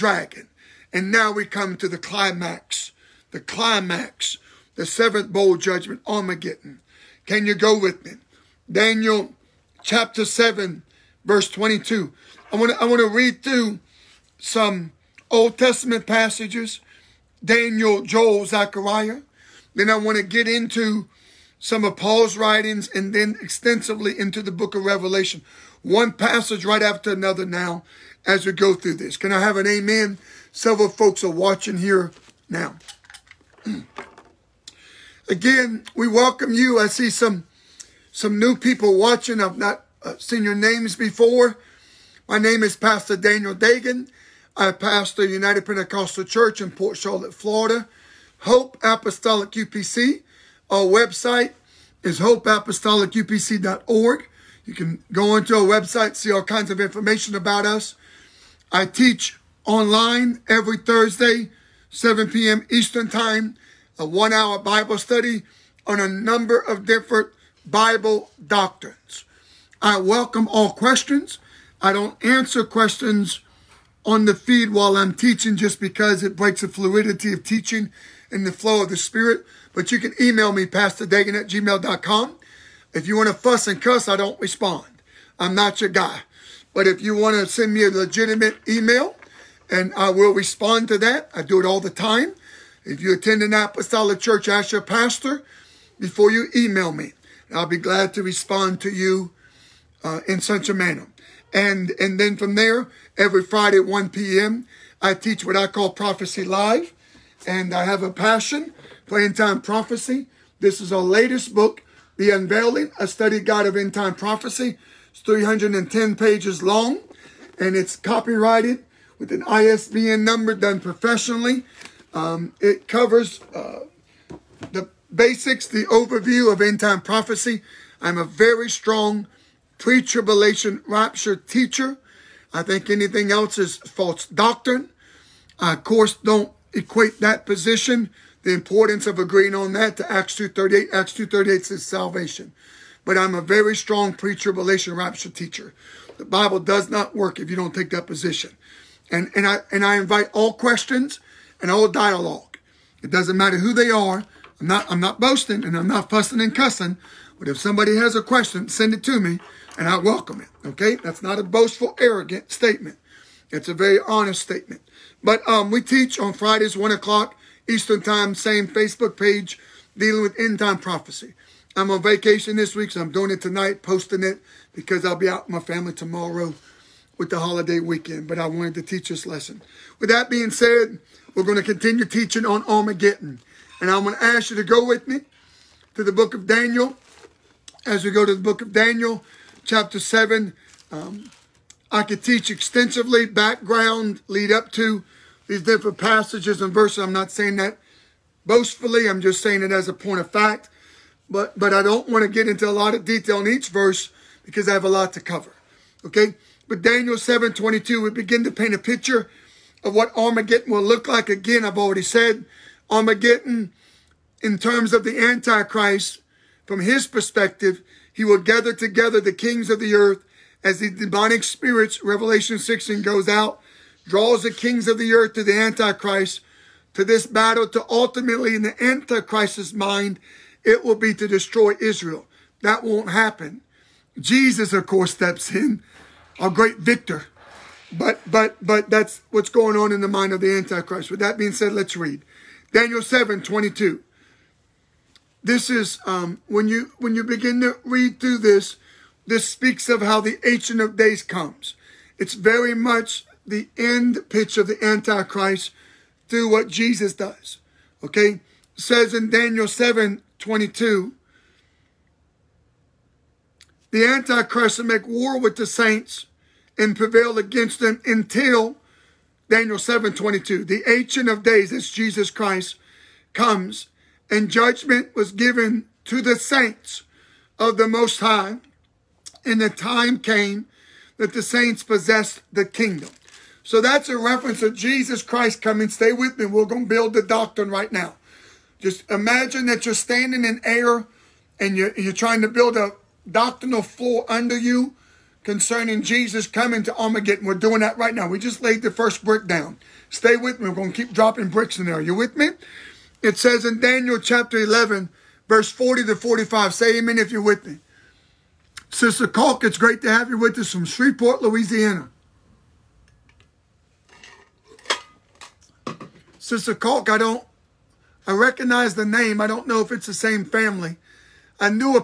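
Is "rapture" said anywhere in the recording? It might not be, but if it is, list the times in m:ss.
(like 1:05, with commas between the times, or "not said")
2:10, 2:24.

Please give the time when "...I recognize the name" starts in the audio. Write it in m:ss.
5:18.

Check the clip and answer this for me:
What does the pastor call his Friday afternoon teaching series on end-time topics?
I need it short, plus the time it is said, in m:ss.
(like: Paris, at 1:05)
Prophecy Live, at 1:45.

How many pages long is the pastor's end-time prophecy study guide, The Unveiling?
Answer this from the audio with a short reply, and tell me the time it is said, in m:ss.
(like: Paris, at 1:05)
310, at 1:55.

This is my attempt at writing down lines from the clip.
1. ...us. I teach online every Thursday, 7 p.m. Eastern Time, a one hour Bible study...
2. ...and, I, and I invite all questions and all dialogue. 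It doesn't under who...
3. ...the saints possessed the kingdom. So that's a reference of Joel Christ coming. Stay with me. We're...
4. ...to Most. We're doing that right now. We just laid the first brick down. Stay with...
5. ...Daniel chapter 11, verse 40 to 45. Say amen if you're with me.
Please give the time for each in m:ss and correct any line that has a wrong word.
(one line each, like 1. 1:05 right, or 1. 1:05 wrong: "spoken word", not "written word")
1. 0:57 right
2. 2:29 wrong: "matter", not "under"
3. 4:41 wrong: "Jesus", not "Joel"
4. 4:56 wrong: "Armageddon", not "Most"
5. 5:03 right.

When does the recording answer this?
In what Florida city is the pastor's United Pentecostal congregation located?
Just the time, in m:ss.
0:46.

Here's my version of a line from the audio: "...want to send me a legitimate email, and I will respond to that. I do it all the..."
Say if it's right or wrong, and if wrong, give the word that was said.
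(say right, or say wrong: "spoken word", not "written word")
right.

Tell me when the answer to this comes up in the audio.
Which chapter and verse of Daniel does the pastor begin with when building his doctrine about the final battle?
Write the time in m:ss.
0:08.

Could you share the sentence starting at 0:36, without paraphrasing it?
I see some some new people watching.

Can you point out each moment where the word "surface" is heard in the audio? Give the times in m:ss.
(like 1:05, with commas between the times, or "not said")
not said.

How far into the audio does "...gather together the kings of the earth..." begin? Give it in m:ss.
3:38.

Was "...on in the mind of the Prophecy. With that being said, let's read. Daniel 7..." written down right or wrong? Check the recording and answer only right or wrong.
wrong.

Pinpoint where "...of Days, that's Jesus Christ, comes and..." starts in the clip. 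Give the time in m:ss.
4:31.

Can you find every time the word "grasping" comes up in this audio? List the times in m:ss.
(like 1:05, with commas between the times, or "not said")
not said.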